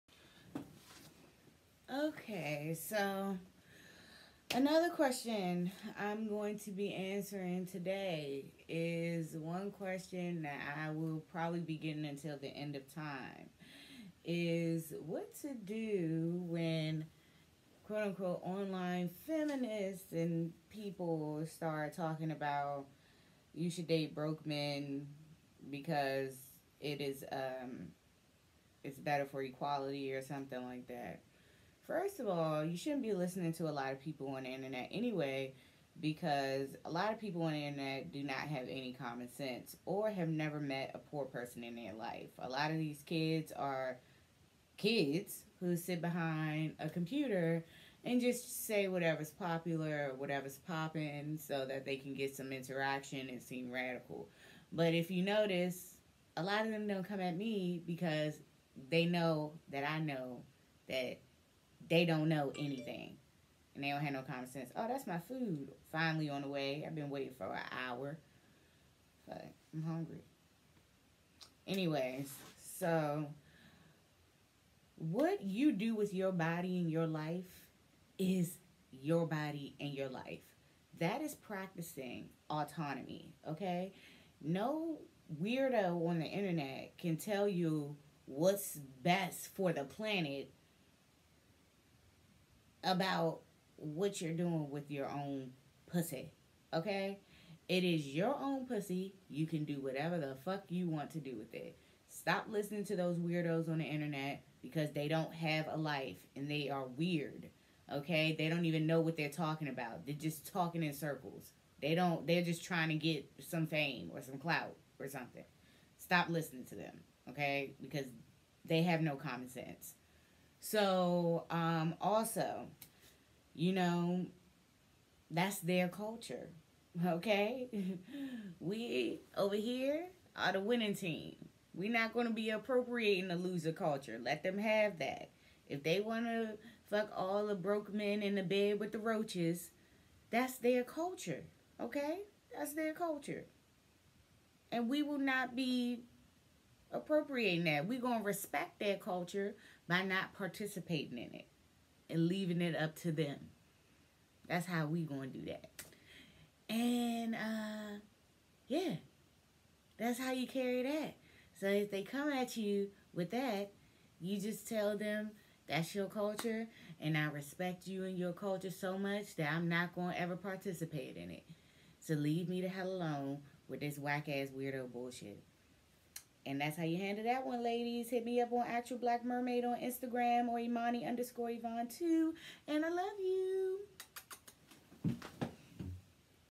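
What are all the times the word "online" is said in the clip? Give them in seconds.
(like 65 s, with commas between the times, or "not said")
18 s.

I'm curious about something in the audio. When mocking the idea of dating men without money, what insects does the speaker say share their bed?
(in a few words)
Roaches.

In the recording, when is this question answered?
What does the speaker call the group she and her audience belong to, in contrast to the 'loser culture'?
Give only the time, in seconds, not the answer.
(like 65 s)
130 s.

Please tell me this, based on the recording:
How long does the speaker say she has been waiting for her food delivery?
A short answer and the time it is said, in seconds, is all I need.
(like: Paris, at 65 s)
An hour, at 67 s.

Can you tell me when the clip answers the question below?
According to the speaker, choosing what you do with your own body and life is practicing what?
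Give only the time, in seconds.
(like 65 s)
82 s.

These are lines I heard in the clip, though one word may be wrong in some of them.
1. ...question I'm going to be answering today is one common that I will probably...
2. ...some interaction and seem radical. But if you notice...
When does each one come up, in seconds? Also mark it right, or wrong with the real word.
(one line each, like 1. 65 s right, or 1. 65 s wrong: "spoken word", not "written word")
1. 4 s wrong: "question", not "common"
2. 52 s right.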